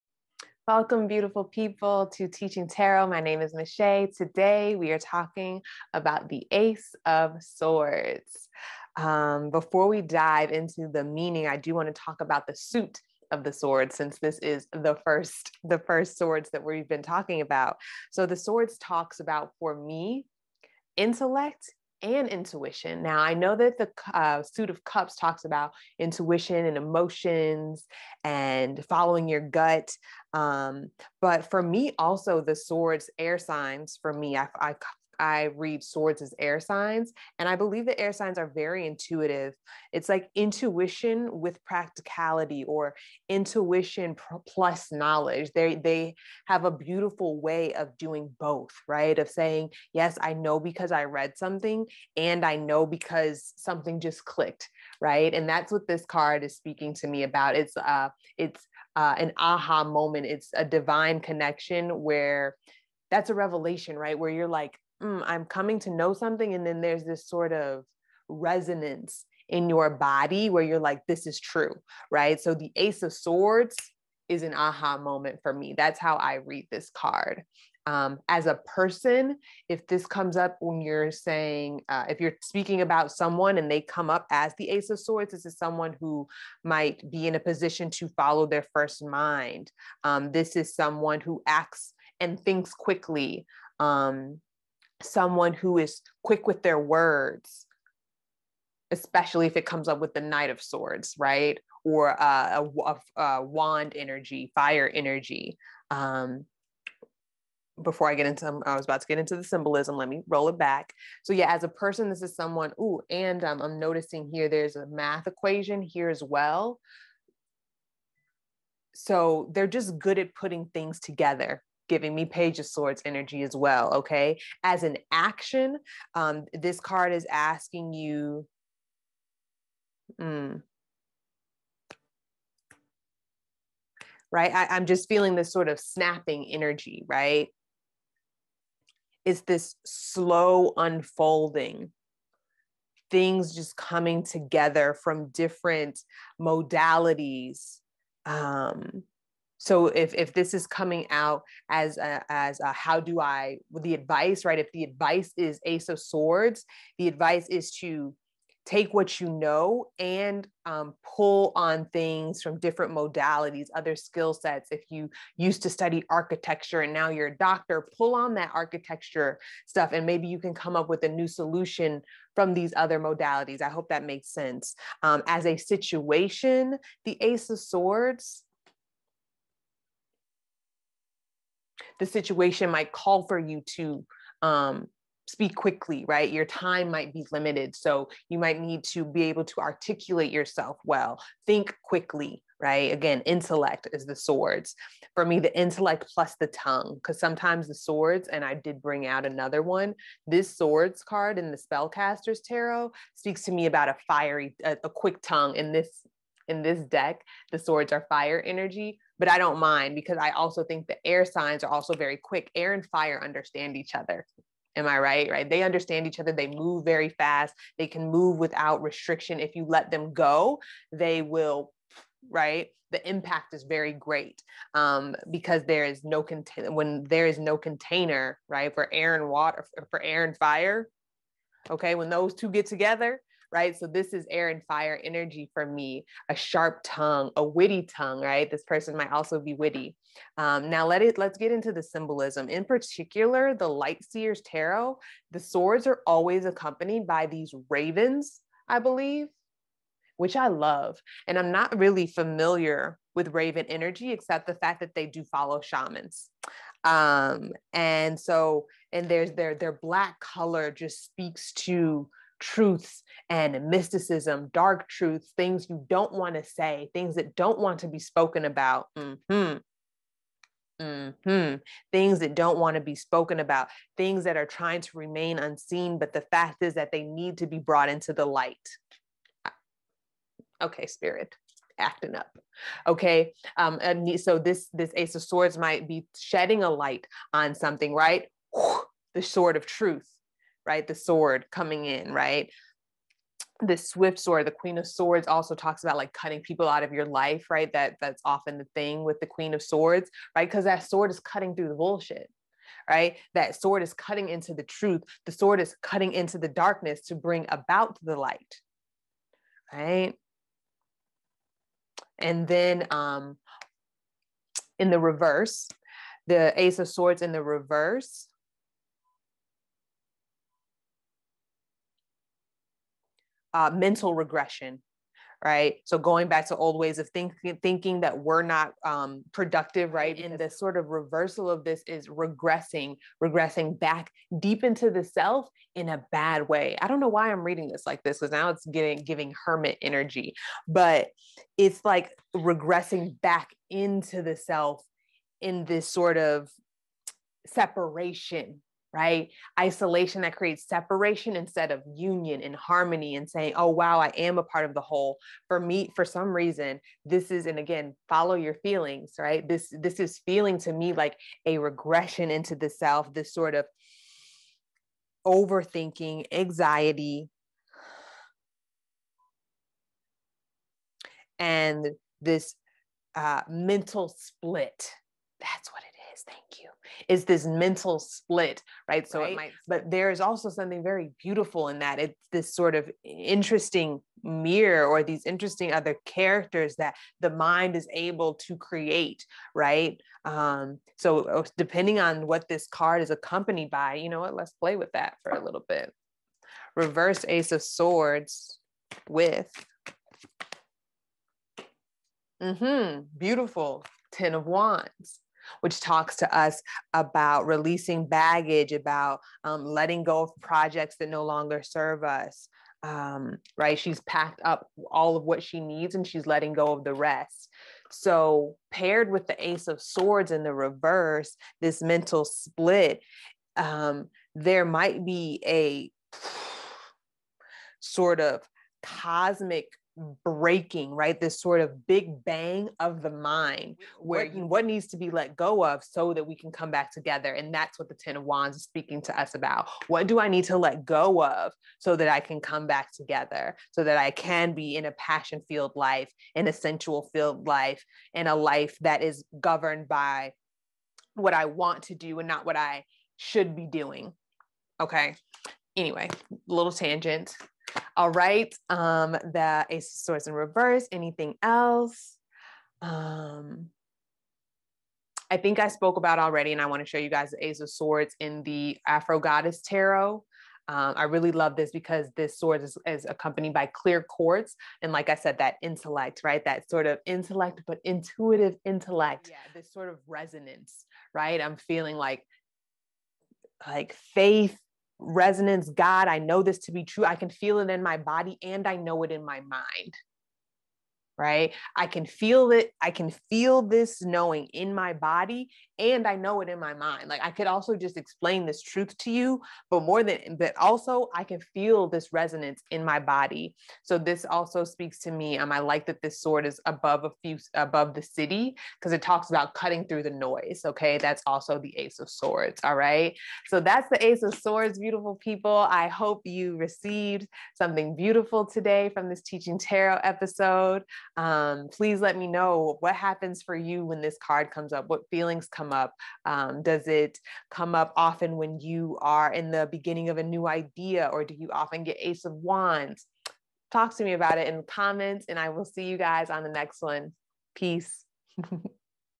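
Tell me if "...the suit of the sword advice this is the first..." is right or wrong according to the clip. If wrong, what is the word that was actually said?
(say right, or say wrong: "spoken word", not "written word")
wrong: "since", not "advice".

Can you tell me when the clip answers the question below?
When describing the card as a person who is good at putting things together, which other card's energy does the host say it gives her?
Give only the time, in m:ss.
2:02.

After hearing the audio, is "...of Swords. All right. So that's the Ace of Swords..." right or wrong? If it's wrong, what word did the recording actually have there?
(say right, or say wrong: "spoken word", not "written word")
right.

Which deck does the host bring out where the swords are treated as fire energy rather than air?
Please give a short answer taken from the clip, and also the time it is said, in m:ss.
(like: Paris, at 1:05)
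spellcaster's tarot, at 3:21.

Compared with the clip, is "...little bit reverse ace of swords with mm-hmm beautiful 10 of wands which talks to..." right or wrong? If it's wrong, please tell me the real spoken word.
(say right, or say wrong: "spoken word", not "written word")
right.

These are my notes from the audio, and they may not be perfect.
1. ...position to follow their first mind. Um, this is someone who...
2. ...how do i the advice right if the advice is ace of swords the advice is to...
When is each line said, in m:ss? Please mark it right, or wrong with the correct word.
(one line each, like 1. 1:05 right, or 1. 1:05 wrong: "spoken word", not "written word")
1. 1:27 right
2. 2:32 right.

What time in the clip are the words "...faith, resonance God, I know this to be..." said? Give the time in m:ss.
8:04.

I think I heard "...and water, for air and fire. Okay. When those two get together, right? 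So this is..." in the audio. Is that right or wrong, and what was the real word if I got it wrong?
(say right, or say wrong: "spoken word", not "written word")
right.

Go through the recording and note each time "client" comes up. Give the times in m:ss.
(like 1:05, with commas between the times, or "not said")
not said.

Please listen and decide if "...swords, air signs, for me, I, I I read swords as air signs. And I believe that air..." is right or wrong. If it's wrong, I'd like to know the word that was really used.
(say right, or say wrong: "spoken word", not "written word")
right.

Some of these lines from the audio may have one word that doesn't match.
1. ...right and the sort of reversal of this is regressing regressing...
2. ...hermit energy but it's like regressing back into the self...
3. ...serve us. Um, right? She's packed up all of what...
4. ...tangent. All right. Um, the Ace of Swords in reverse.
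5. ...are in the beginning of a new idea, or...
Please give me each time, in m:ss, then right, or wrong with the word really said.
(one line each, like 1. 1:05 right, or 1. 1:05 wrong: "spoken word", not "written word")
1. 5:29 right
2. 5:39 right
3. 6:51 right
4. 7:36 right
5. 8:49 right.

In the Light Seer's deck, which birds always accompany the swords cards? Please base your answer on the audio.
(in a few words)
ravens.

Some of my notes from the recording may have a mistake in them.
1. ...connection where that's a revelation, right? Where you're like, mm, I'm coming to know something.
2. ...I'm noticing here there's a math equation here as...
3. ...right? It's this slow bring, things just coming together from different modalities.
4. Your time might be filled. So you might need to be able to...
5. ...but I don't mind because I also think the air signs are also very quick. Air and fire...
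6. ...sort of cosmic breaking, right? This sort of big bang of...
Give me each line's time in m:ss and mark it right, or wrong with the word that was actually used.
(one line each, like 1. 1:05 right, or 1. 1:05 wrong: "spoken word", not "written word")
1. 1:01 right
2. 1:53 right
3. 2:17 wrong: "unfolding", not "bring"
4. 3:06 wrong: "limited", not "filled"
5. 3:29 right
6. 7:07 right.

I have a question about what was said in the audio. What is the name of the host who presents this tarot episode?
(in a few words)
Michelle.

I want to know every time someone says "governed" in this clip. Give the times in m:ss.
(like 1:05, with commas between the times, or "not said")
7:29.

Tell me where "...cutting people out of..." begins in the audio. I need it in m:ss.
4:56.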